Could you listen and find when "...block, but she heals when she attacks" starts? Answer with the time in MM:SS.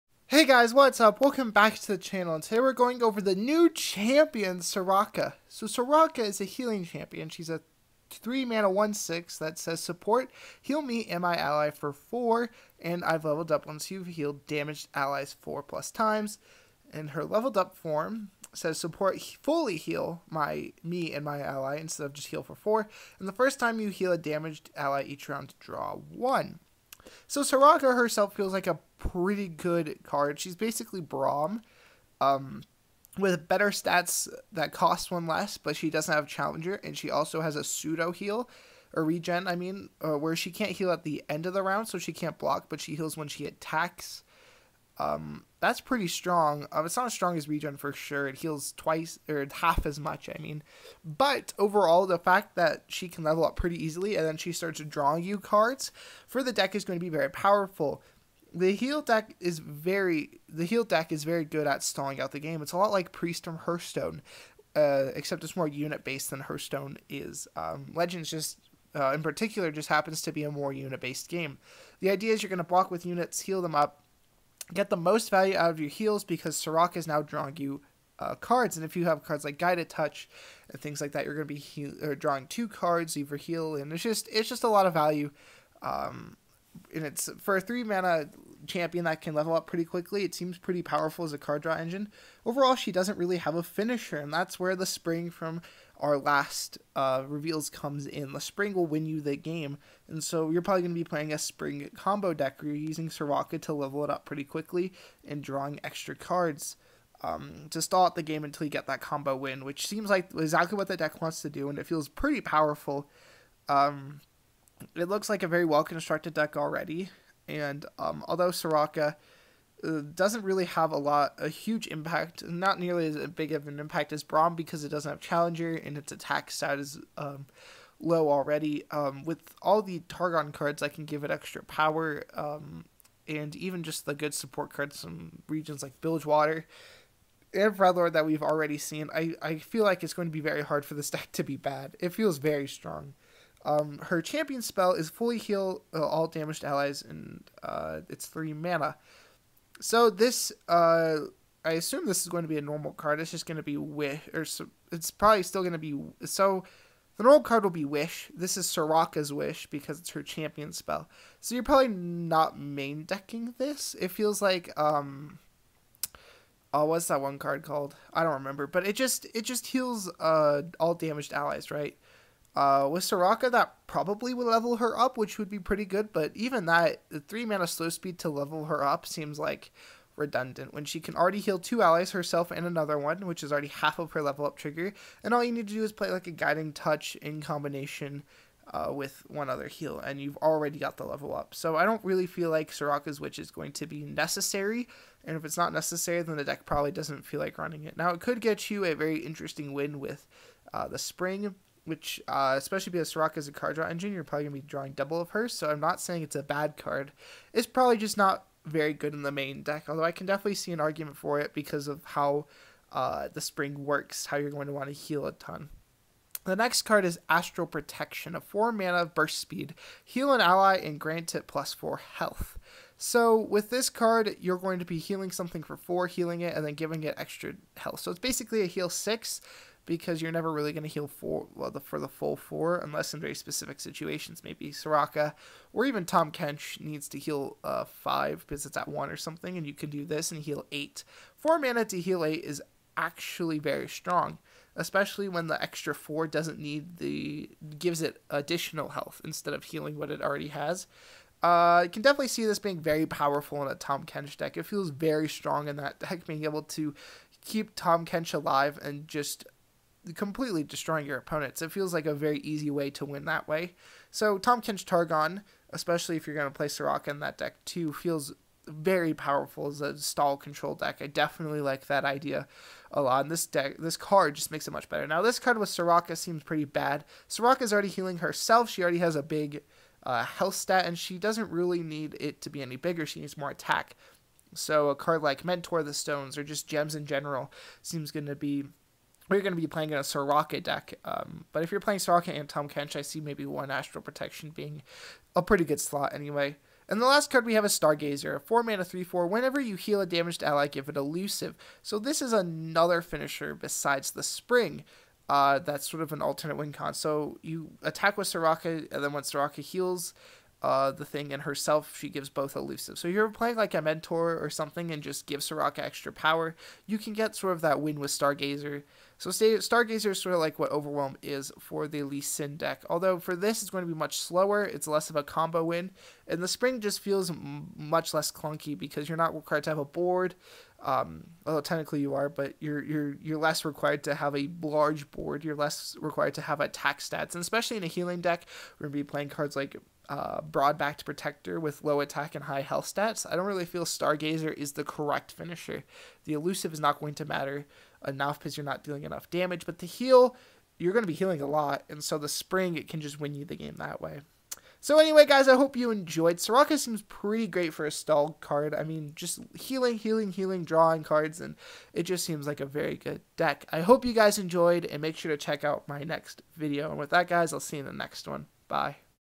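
00:42.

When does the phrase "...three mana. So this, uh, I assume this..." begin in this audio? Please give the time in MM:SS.
02:28.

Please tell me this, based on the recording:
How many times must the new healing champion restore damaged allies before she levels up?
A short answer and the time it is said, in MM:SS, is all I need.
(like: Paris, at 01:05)
4, at 00:15.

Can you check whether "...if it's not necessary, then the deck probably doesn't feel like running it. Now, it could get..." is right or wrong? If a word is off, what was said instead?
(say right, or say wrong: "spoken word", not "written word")
right.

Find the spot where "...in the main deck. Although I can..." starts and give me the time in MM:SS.
03:29.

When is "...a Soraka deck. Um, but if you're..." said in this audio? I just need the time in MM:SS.
04:49.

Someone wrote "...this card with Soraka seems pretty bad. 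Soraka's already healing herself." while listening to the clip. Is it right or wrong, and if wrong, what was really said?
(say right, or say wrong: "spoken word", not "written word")
right.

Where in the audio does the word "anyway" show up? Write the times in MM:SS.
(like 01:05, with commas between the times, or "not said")
04:56, 05:54.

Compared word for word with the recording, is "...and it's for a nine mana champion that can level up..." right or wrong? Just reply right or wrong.
wrong.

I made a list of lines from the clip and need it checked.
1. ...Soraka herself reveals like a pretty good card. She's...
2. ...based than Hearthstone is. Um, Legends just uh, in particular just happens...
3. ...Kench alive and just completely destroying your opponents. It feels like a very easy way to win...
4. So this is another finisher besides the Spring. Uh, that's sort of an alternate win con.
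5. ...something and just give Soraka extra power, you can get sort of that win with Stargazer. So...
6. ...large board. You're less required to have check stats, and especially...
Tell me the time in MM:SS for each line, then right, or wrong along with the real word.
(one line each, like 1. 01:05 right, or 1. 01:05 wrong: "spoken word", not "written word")
1. 00:27 wrong: "feels", not "reveals"
2. 01:06 right
3. 04:18 right
4. 05:01 right
5. 05:14 right
6. 05:34 wrong: "attack", not "check".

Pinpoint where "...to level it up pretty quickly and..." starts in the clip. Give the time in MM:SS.
01:43.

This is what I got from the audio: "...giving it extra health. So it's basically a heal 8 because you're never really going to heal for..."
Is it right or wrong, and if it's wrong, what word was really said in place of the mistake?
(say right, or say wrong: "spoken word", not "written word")
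wrong: "6", not "8".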